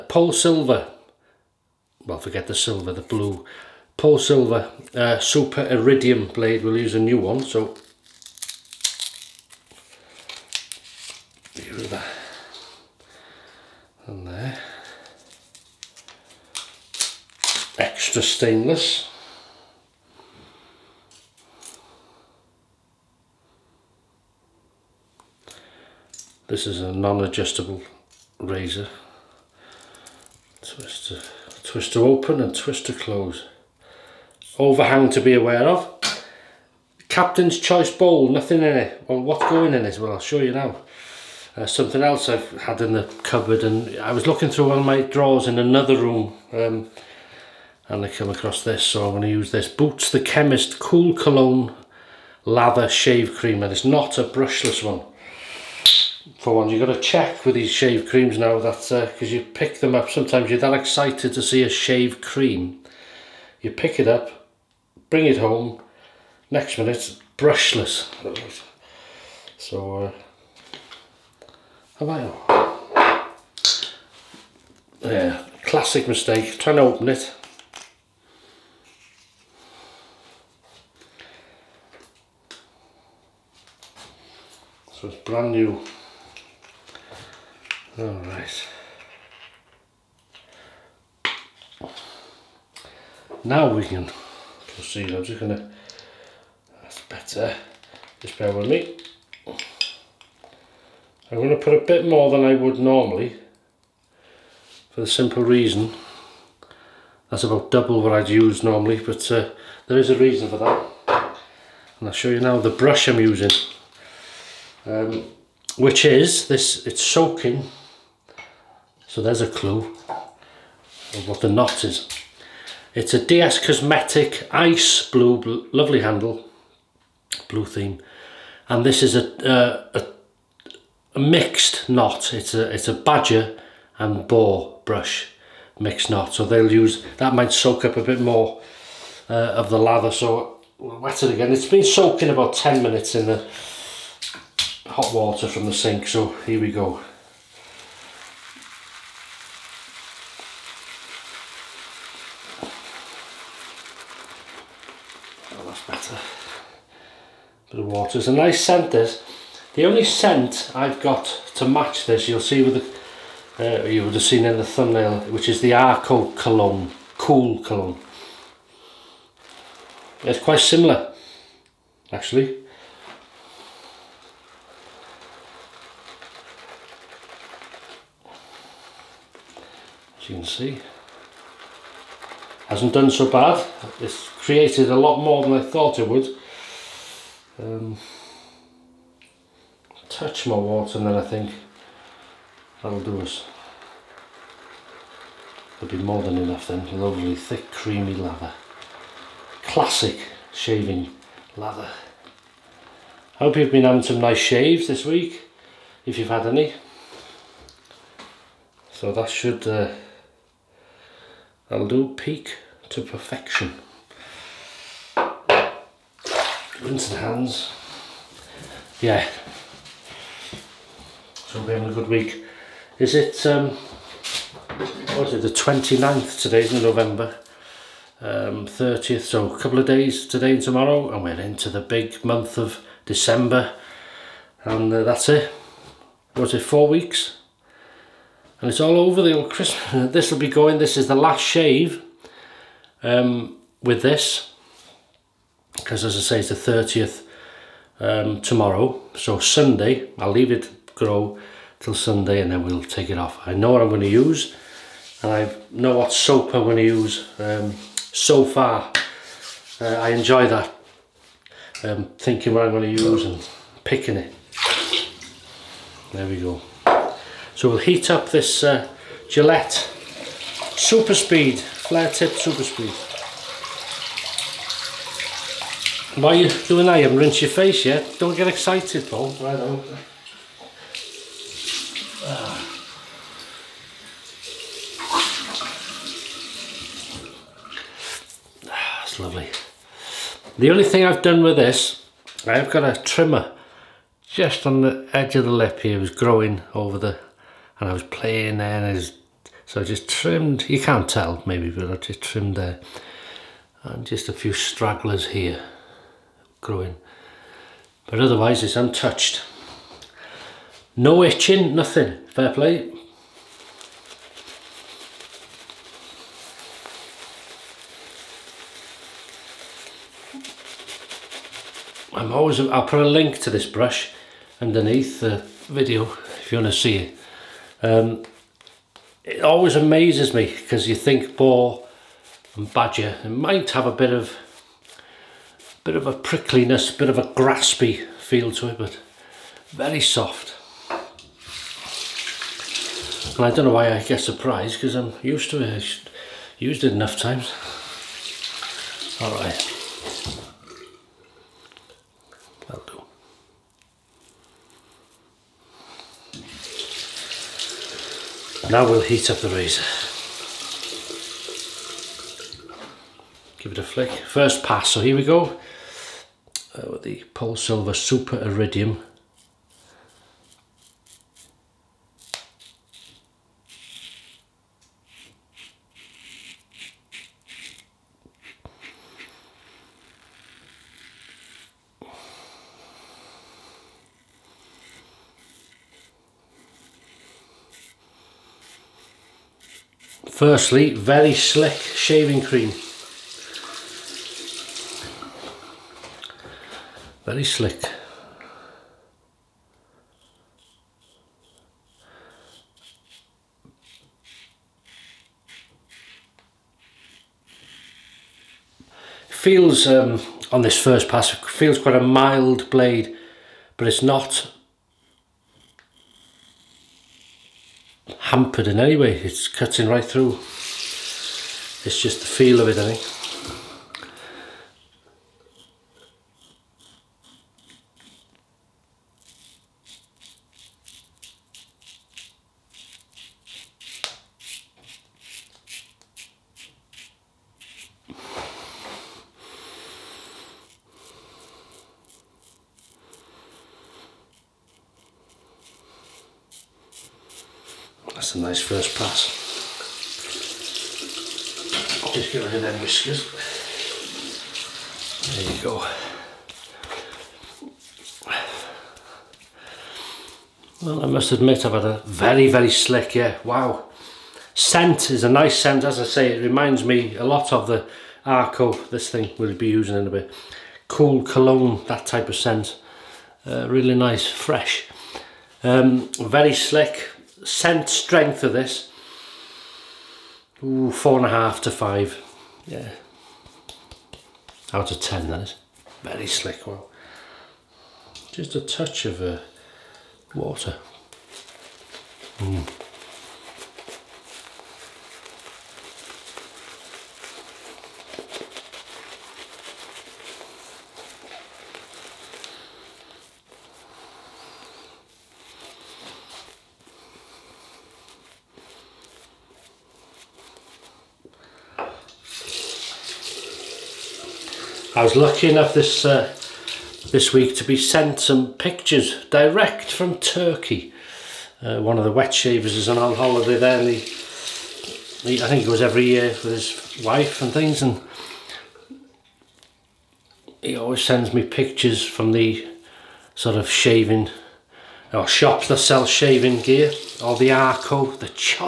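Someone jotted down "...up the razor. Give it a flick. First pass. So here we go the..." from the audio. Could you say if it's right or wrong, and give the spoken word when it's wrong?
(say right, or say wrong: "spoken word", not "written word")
right.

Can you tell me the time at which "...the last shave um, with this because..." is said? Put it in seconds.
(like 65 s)
241 s.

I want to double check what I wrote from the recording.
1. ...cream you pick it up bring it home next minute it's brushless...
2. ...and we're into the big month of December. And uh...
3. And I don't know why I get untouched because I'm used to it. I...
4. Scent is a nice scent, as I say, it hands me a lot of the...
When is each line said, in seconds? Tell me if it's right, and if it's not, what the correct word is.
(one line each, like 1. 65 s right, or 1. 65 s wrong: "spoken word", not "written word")
1. 62 s right
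2. 231 s right
3. 343 s wrong: "surprised", not "untouched"
4. 464 s wrong: "reminds", not "hands".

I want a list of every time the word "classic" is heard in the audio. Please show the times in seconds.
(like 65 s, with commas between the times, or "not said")
75 s, 199 s.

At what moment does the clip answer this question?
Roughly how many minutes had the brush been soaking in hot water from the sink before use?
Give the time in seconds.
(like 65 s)
142 s.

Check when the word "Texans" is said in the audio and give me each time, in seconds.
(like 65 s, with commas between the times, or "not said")
not said.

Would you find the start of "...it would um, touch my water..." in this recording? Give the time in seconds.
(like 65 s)
185 s.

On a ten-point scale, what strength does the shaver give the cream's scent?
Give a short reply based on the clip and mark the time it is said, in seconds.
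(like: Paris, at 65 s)
4.5 to 5, at 480 s.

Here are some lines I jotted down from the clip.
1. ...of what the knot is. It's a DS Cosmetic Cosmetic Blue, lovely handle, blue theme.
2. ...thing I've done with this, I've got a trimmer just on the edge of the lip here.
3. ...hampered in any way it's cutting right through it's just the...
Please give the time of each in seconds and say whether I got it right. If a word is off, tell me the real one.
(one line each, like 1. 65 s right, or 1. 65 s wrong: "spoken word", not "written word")
1. 120 s wrong: "Ice", not "Cosmetic"
2. 290 s right
3. 418 s right.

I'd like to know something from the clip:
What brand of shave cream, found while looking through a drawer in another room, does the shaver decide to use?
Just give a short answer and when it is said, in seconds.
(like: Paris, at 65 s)
Boots, at 49 s.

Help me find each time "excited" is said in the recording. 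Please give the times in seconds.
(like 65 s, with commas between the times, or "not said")
60 s, 278 s.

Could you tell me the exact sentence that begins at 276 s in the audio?
You haven't rinsed your face yet.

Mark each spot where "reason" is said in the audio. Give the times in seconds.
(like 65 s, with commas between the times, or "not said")
105 s, 110 s.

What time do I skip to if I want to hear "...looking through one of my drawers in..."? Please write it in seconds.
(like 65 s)
44 s.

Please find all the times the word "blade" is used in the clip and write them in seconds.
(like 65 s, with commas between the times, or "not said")
6 s, 412 s.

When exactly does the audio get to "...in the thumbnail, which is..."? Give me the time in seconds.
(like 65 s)
164 s.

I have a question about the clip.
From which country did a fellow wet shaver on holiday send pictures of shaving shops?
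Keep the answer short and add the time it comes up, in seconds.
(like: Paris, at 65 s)
Turkey, at 520 s.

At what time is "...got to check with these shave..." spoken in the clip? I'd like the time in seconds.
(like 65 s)
56 s.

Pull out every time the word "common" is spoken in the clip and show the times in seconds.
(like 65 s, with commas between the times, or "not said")
not said.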